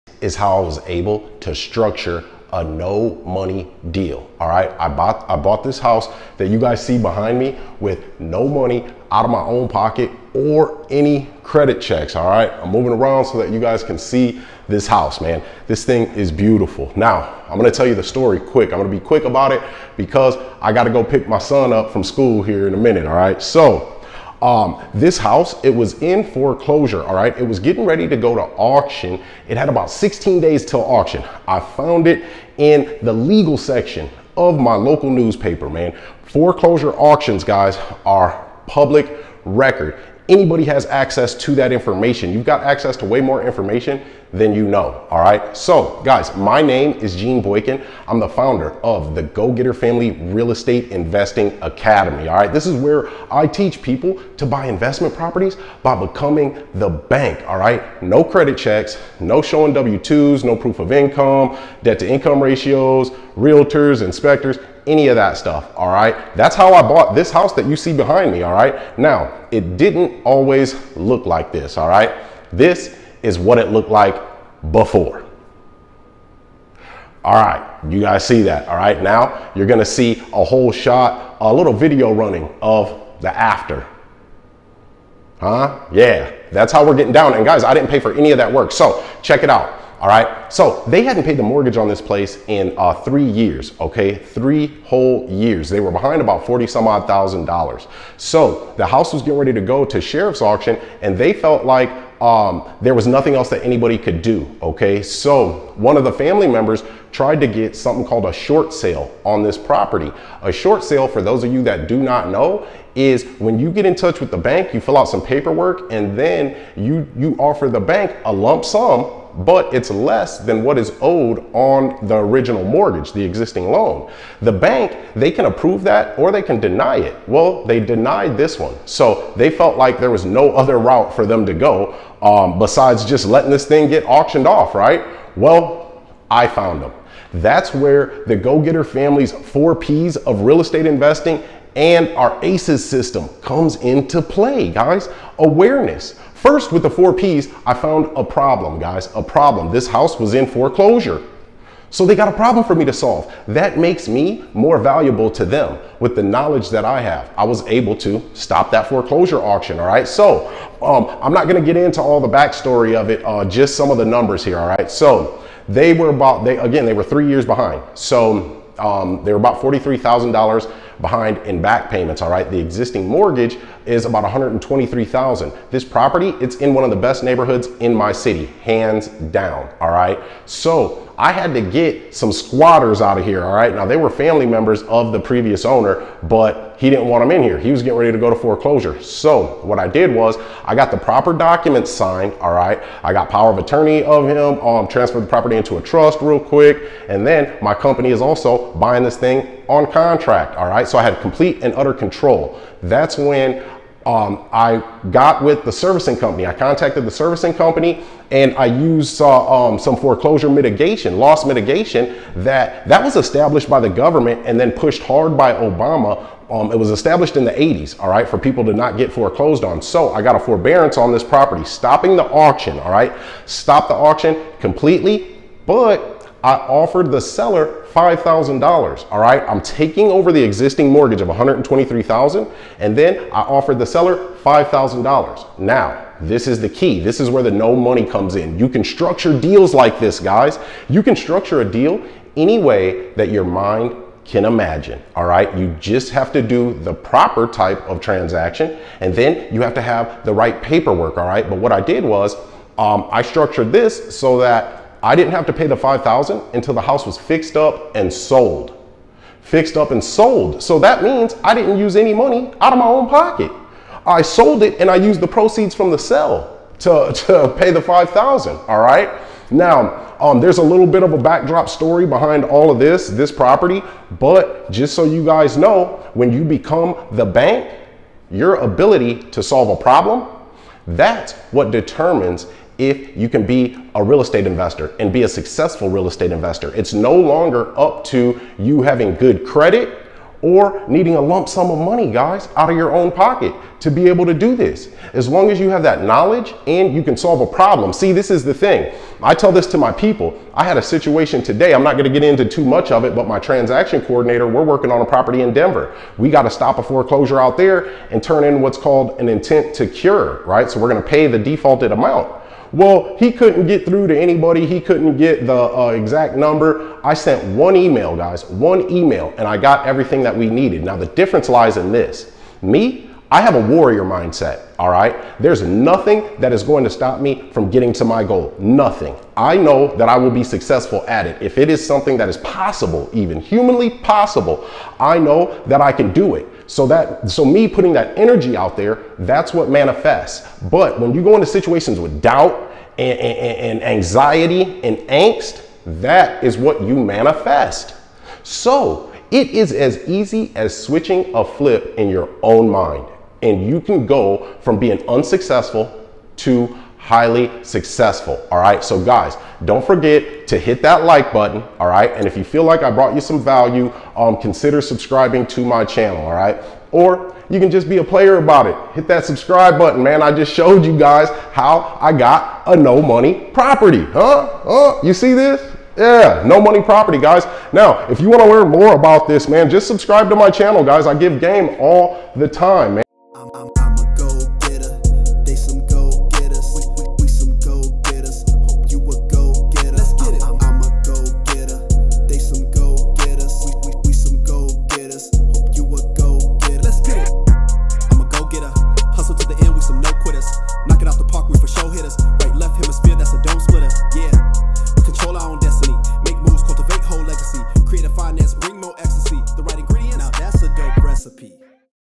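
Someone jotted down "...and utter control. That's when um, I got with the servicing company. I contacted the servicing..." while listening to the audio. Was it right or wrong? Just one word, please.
right.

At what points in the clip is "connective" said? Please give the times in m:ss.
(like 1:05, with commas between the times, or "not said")
not said.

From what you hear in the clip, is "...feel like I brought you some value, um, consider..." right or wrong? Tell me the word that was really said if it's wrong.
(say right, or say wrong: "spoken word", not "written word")
right.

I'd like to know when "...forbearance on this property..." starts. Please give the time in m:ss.
3:40.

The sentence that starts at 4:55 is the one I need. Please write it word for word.
As long as you have that knowledge and you can solve a problem.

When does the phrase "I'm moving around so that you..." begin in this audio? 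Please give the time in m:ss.
0:12.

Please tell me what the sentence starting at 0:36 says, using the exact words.
Foreclosure auctions, guys, are public record.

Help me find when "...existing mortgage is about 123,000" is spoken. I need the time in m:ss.
2:52.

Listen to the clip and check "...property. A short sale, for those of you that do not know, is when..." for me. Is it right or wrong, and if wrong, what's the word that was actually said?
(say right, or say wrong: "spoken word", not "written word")
right.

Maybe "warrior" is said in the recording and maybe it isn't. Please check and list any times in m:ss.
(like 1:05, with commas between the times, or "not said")
5:23.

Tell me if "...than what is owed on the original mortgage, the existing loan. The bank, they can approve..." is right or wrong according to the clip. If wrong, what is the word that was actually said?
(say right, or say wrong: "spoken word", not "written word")
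right.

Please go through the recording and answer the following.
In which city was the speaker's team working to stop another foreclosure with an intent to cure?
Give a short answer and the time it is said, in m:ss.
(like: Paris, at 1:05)
Denver, at 5:05.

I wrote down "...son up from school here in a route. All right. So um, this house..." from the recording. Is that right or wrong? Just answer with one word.
wrong.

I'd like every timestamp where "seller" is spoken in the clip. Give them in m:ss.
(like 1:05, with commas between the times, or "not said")
3:47, 3:53.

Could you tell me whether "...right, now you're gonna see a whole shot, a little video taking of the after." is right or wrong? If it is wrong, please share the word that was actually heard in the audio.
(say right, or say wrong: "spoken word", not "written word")
wrong: "running", not "taking".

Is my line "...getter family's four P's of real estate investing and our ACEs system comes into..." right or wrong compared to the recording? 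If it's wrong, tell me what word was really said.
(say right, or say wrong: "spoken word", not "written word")
right.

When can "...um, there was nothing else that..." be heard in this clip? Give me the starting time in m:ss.
1:42.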